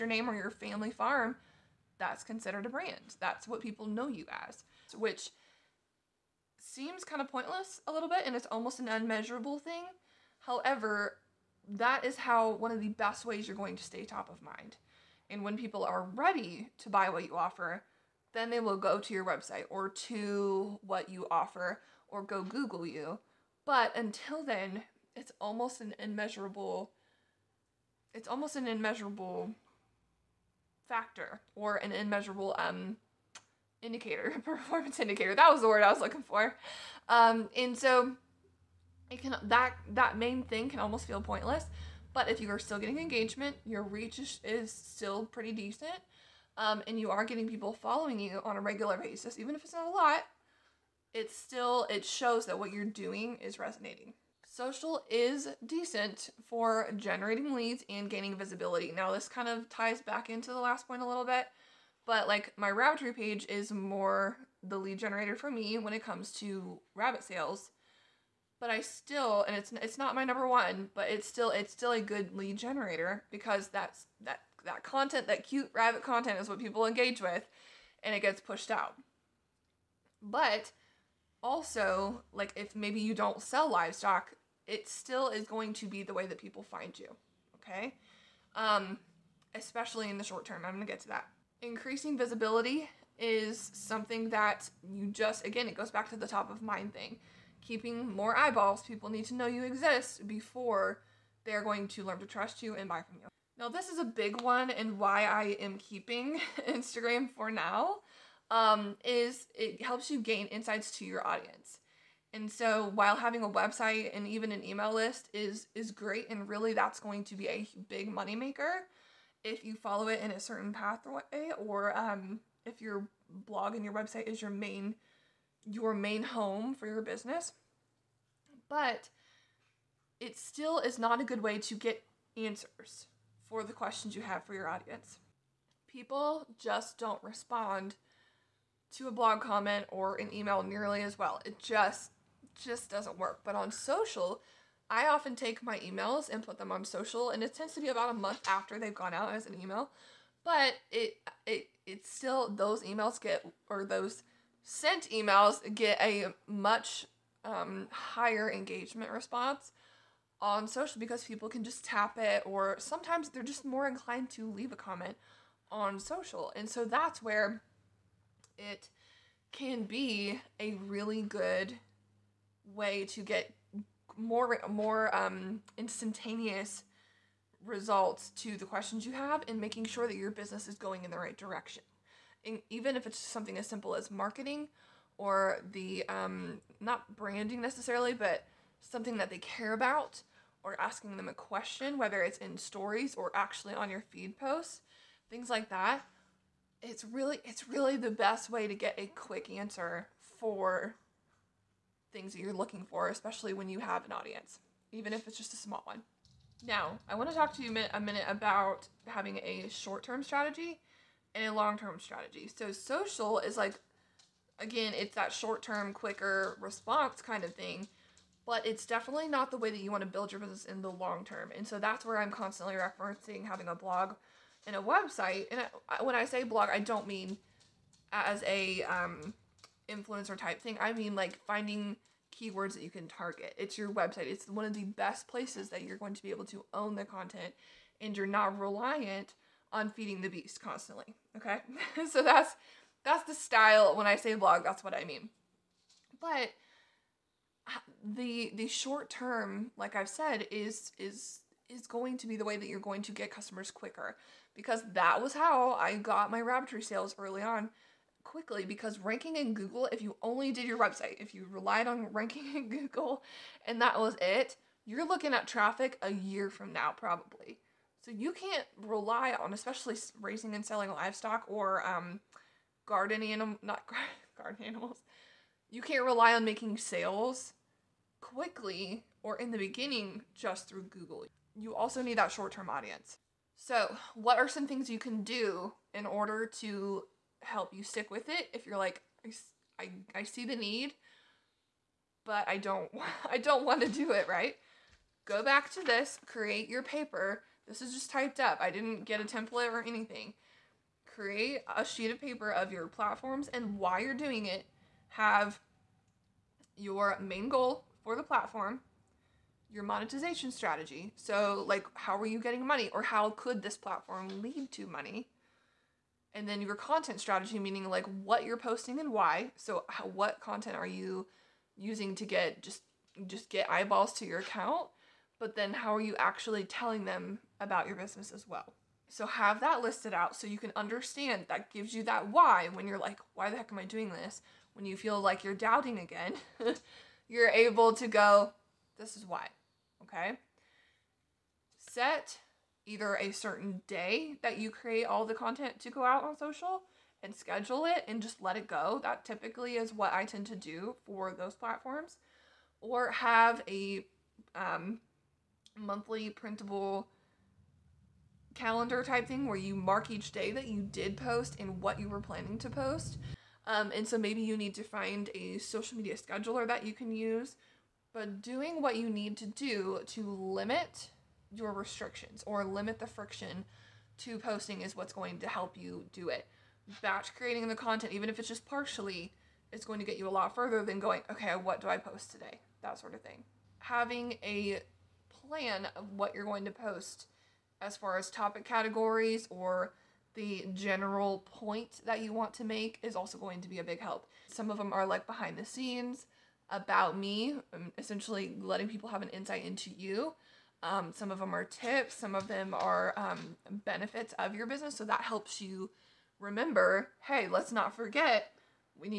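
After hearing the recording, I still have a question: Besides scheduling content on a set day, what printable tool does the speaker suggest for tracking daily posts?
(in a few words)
monthly printable calendar.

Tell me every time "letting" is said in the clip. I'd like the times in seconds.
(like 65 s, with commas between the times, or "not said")
398 s.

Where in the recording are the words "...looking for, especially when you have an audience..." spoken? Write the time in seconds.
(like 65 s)
202 s.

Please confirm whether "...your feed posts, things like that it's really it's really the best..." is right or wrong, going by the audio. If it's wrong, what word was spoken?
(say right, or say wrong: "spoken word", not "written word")
right.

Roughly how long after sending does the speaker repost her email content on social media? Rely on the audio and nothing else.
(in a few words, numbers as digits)
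about a month.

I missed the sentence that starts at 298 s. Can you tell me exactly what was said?
I didn't get a template or anything.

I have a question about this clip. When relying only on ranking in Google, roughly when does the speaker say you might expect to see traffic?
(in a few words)
a year from now.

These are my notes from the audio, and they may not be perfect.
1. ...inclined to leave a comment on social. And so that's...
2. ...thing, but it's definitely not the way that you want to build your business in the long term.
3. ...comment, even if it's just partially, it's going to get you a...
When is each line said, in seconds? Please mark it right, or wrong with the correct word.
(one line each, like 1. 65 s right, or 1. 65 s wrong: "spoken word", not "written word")
1. 163 s right
2. 217 s right
3. 377 s wrong: "content", not "comment".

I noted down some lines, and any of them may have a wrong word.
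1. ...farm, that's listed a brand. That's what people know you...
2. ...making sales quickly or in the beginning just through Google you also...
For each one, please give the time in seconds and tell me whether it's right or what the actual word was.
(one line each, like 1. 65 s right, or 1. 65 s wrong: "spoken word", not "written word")
1. 0 s wrong: "considered", not "listed"
2. 276 s right.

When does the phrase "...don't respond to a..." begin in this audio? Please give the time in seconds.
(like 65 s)
136 s.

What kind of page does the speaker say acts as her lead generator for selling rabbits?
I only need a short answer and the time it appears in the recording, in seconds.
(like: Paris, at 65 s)
Rabbitry page, at 62 s.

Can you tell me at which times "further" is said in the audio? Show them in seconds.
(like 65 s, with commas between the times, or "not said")
380 s.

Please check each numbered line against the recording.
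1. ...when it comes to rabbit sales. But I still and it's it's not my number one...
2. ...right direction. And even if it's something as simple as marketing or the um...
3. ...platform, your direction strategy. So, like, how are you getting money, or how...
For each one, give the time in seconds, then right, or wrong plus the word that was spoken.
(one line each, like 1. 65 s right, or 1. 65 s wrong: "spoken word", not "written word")
1. 65 s right
2. 181 s right
3. 308 s wrong: "monetization", not "direction".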